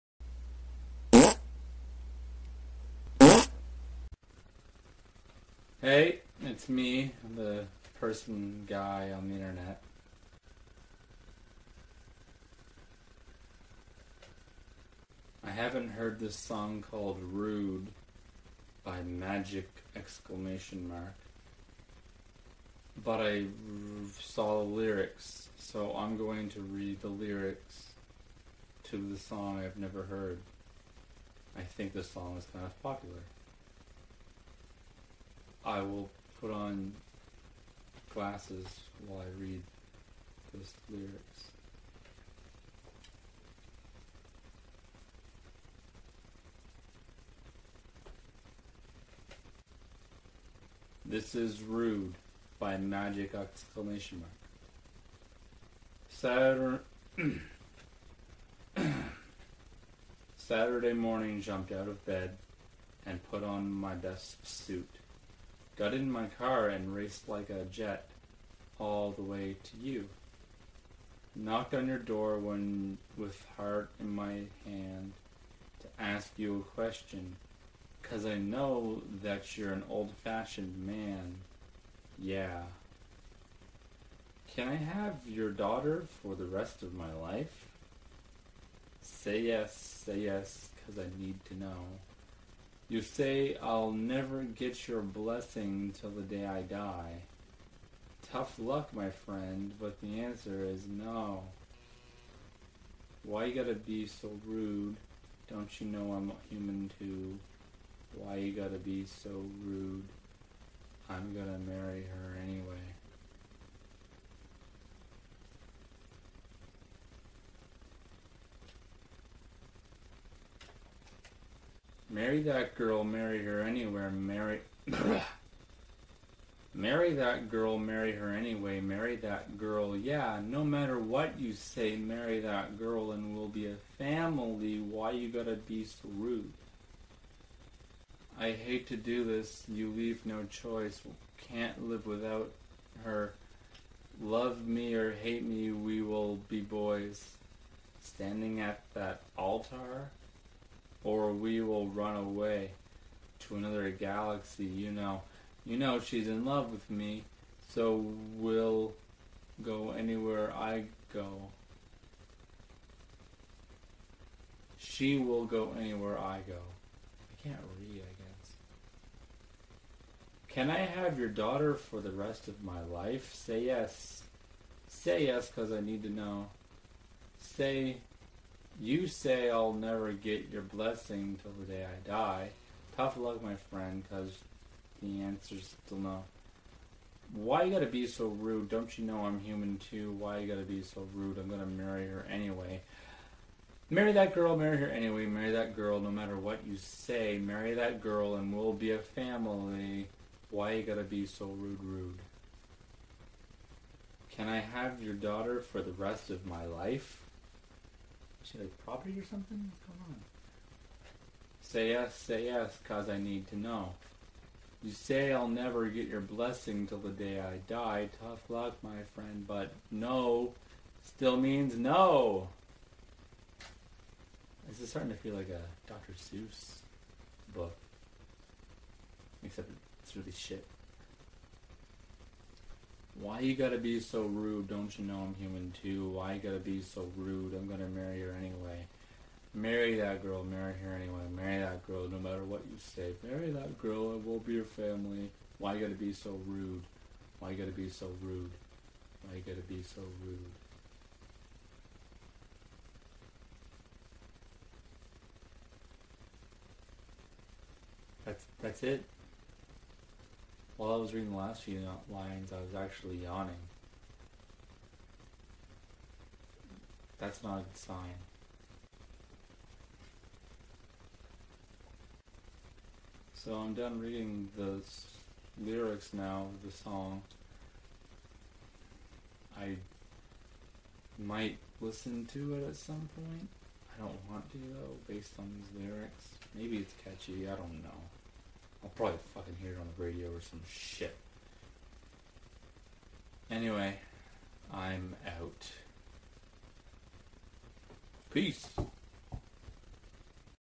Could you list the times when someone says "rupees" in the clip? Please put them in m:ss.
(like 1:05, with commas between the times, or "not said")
not said.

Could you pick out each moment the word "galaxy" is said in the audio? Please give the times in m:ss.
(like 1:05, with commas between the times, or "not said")
2:33.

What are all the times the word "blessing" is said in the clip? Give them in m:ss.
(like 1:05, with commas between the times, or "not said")
1:34, 3:00, 3:36.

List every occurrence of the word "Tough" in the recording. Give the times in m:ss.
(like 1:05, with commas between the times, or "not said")
1:38, 3:02, 3:38.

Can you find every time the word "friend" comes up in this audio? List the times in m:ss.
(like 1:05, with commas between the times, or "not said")
1:39, 3:03, 3:39.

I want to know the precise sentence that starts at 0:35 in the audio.
I will put on glasses while I read those lyrics.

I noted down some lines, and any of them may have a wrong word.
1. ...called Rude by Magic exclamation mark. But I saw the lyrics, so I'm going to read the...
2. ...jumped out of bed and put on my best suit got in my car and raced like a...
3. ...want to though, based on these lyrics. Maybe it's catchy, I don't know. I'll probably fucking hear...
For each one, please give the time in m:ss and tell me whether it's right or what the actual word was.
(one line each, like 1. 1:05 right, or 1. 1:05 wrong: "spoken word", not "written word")
1. 0:16 right
2. 1:01 right
3. 4:44 right.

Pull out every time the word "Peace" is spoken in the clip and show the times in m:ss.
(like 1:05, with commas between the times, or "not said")
4:58.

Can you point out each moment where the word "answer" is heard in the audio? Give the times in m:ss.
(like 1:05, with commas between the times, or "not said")
1:40, 3:05.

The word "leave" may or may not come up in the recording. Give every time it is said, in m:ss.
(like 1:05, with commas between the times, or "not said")
2:19.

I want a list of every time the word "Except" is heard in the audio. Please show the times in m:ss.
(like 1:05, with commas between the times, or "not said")
3:49.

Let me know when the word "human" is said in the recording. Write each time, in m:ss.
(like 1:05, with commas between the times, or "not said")
1:46, 3:09, 3:55.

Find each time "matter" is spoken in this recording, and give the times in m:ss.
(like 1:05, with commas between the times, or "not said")
2:10, 3:16, 4:02.